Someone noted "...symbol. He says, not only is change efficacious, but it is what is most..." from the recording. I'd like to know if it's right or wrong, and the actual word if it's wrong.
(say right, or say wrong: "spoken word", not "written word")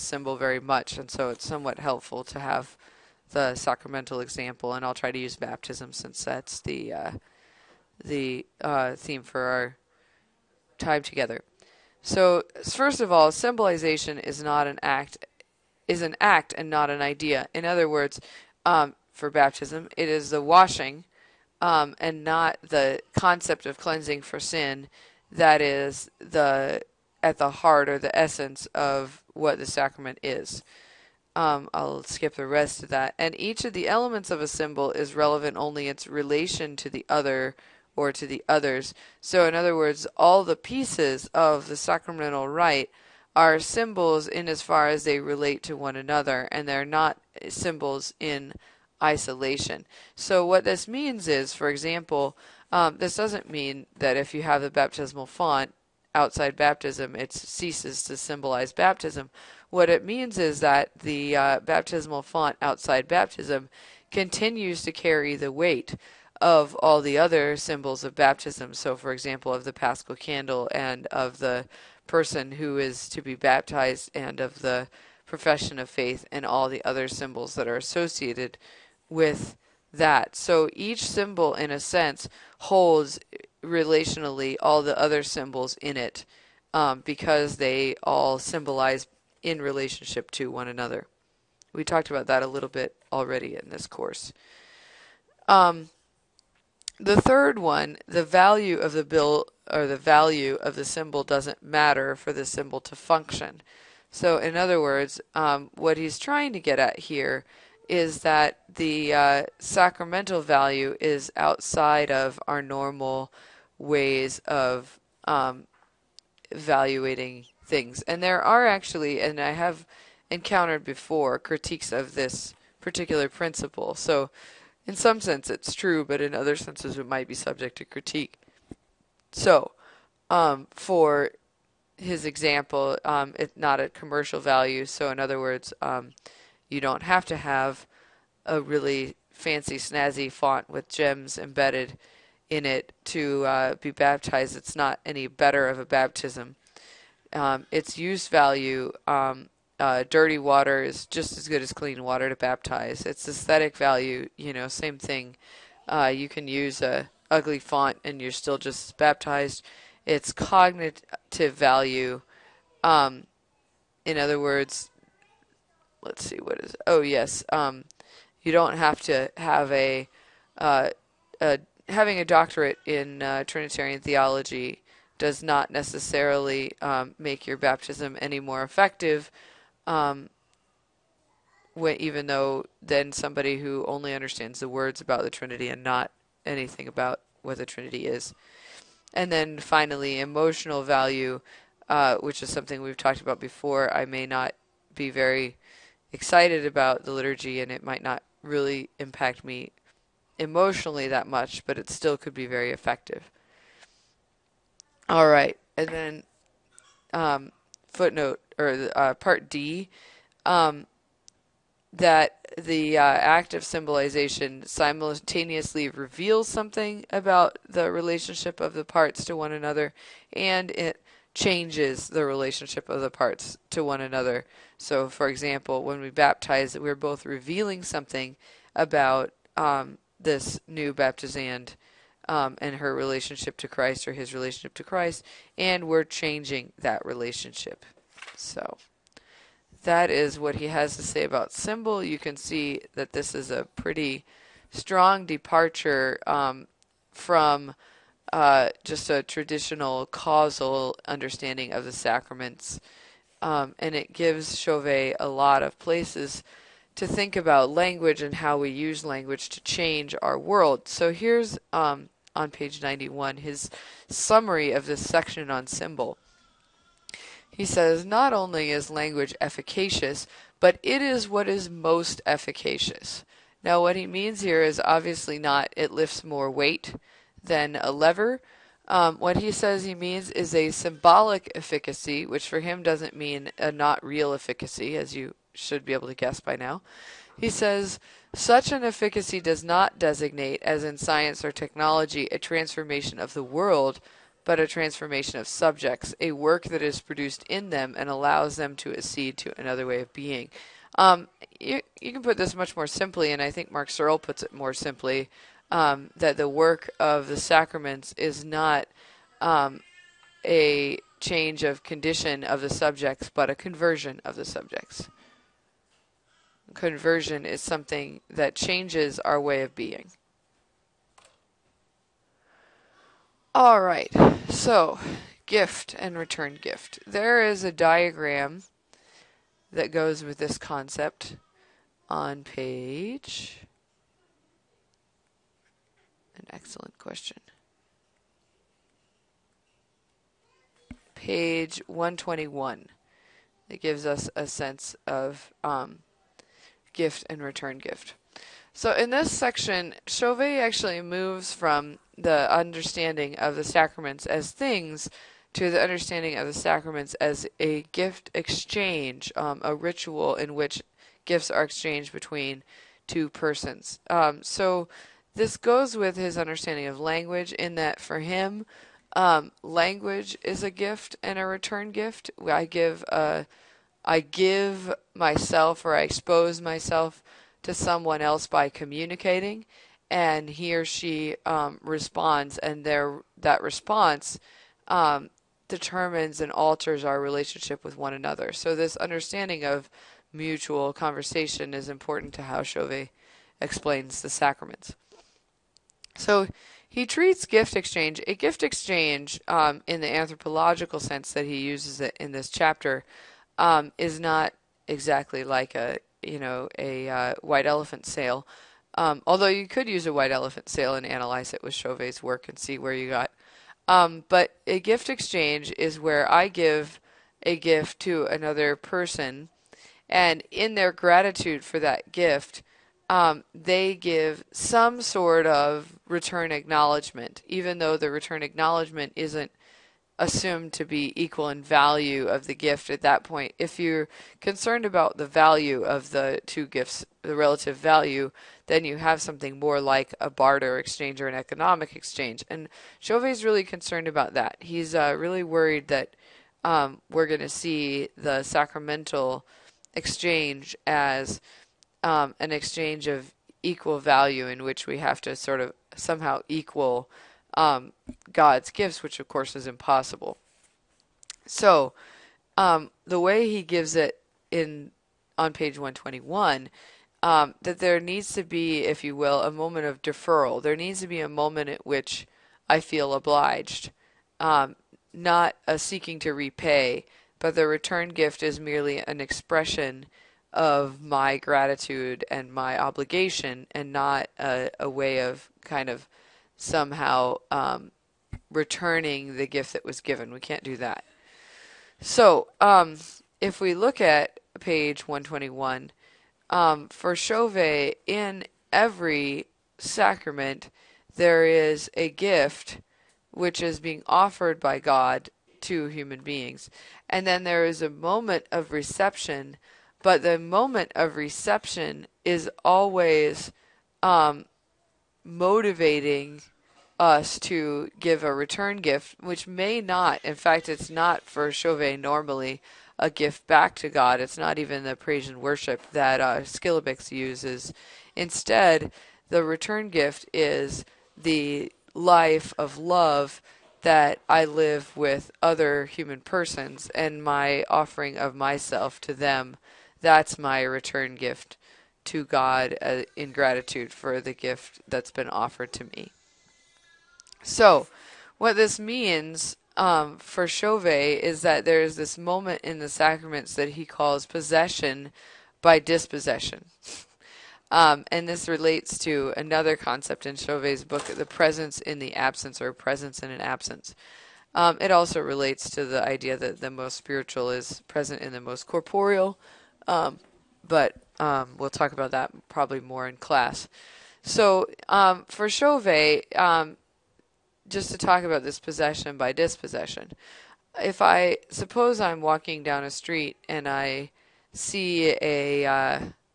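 wrong: "language", not "change".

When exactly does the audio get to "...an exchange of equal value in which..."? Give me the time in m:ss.
7:32.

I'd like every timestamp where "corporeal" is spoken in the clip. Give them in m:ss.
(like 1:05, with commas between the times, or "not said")
9:28.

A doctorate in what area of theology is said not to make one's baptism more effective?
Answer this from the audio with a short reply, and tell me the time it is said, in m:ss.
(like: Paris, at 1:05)
Trinitarian theology, at 2:53.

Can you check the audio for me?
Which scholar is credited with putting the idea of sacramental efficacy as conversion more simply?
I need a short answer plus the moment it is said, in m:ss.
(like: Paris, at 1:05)
Mark Searle, at 5:03.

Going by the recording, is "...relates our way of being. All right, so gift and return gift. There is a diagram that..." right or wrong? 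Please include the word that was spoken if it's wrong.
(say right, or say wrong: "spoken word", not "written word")
wrong: "changes", not "relates".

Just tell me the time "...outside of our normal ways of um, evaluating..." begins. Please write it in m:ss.
1:51.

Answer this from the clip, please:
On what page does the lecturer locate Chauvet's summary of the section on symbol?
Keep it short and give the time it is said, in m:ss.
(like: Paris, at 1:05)
91, at 4:22.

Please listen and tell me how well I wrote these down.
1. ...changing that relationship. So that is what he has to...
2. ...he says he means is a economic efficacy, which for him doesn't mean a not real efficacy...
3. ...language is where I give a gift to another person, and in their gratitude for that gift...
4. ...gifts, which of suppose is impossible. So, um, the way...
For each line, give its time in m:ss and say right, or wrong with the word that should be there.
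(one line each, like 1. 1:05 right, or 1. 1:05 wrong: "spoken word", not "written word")
1. 3:56 right
2. 4:39 wrong: "symbolic", not "economic"
3. 6:55 wrong: "exchange", not "language"
4. 7:38 wrong: "course", not "suppose".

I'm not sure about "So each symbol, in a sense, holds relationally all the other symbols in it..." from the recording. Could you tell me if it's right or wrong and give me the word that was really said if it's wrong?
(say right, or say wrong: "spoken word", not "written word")
right.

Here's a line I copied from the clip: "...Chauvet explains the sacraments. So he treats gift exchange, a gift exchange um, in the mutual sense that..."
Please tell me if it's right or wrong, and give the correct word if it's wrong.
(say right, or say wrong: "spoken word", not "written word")
wrong: "anthropological", not "mutual".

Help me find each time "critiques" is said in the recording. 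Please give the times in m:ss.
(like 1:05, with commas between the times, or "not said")
2:01, 2:07.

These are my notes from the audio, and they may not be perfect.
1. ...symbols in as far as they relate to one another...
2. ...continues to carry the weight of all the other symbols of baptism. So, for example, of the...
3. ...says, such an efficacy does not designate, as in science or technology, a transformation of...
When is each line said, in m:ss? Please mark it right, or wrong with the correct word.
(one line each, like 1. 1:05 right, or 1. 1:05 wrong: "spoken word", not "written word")
1. 0:43 right
2. 1:04 right
3. 4:47 right.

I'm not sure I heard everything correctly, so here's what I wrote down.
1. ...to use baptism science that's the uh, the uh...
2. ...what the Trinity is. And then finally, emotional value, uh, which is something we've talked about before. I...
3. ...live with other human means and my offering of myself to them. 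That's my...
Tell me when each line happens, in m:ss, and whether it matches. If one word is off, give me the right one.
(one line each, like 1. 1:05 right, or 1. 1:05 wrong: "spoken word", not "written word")
1. 0:05 wrong: "since", not "science"
2. 3:07 right
3. 8:54 wrong: "persons", not "means".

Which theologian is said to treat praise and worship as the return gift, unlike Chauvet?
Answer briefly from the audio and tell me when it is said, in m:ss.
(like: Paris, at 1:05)
Schillebeeckx, at 8:46.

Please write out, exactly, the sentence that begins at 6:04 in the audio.
Um, so this goes with his understanding of language in that for him, um, language is a gift and a return gift.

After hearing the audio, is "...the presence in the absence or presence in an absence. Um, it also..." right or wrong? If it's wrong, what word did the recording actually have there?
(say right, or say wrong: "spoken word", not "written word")
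right.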